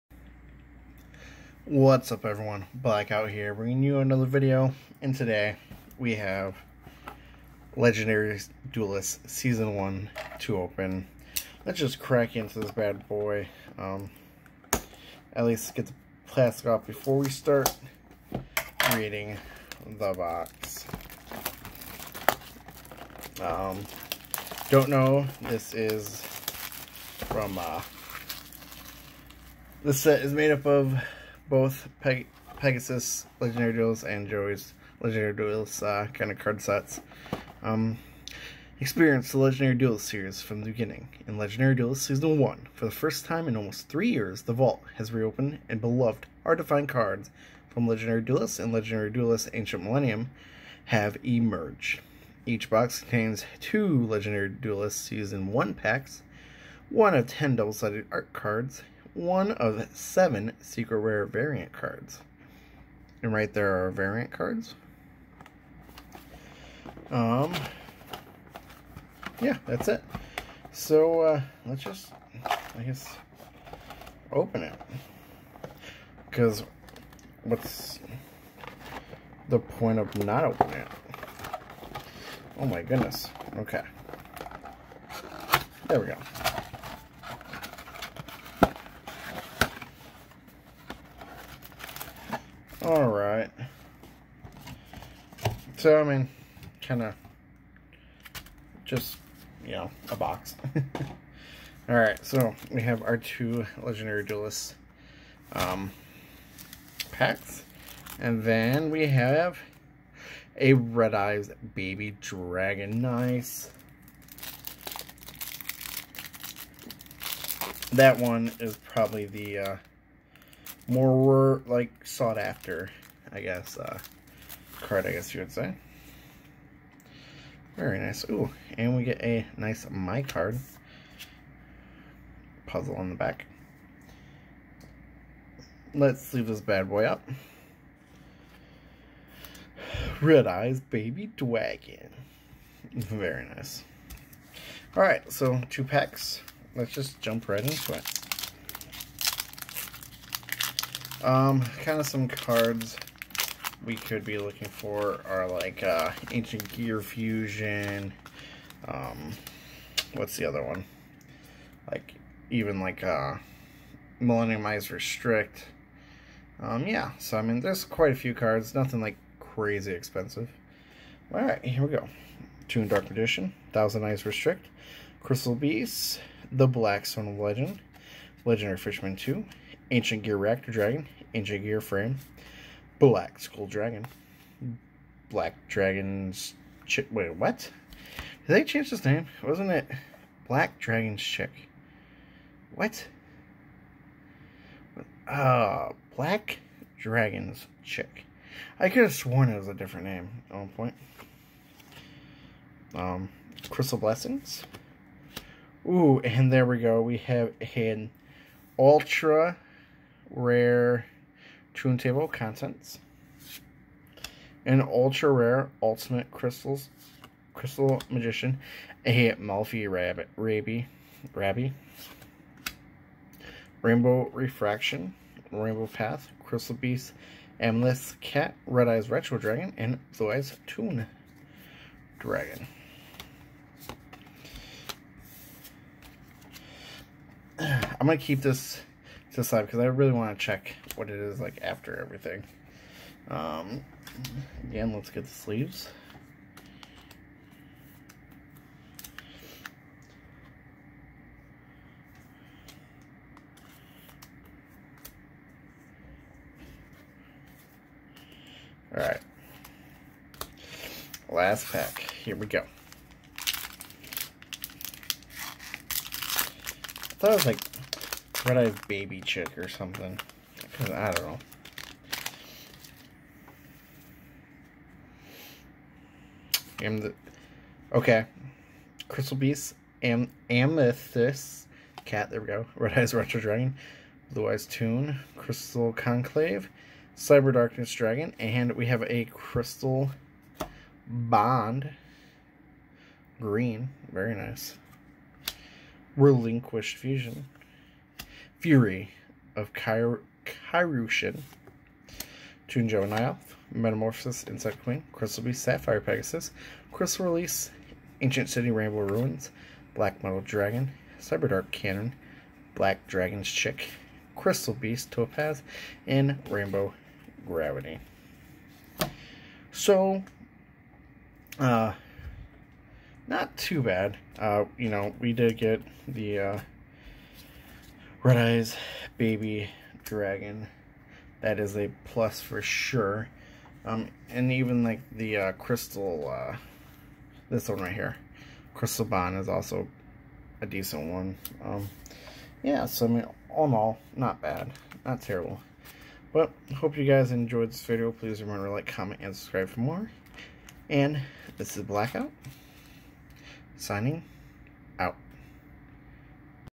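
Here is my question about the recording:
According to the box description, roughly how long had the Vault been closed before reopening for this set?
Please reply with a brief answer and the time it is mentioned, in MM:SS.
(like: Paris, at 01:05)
almost 3 years, at 00:43.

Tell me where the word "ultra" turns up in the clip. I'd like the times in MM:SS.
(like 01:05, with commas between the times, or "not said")
03:28, 03:34.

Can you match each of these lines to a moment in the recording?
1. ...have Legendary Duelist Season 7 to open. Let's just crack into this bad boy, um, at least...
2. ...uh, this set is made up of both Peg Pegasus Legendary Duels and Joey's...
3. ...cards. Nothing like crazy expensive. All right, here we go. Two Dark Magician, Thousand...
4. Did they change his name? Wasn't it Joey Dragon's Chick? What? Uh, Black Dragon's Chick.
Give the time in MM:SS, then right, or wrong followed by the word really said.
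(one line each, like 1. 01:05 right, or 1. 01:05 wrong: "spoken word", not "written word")
1. 00:06 wrong: "1", not "7"
2. 00:27 right
3. 02:48 right
4. 03:08 wrong: "Black", not "Joey".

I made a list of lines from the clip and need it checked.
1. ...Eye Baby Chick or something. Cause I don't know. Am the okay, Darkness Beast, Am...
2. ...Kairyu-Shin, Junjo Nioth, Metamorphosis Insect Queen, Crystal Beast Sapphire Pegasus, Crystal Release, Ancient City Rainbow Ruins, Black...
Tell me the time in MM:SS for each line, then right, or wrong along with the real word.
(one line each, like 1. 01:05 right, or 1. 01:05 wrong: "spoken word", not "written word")
1. 04:28 wrong: "Crystal", not "Darkness"
2. 05:00 right.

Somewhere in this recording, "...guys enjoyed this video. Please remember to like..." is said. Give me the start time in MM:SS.
05:47.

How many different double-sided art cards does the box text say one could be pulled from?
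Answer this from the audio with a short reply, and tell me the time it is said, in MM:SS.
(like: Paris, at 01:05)
10, at 00:57.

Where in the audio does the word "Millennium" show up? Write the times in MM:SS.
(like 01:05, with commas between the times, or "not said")
00:49, 02:44.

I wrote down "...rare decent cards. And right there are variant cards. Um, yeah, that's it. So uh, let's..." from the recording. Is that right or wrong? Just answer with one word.
wrong.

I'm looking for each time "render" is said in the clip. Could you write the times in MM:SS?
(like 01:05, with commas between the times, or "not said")
not said.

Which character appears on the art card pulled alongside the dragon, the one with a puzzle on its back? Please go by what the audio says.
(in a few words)
Mai.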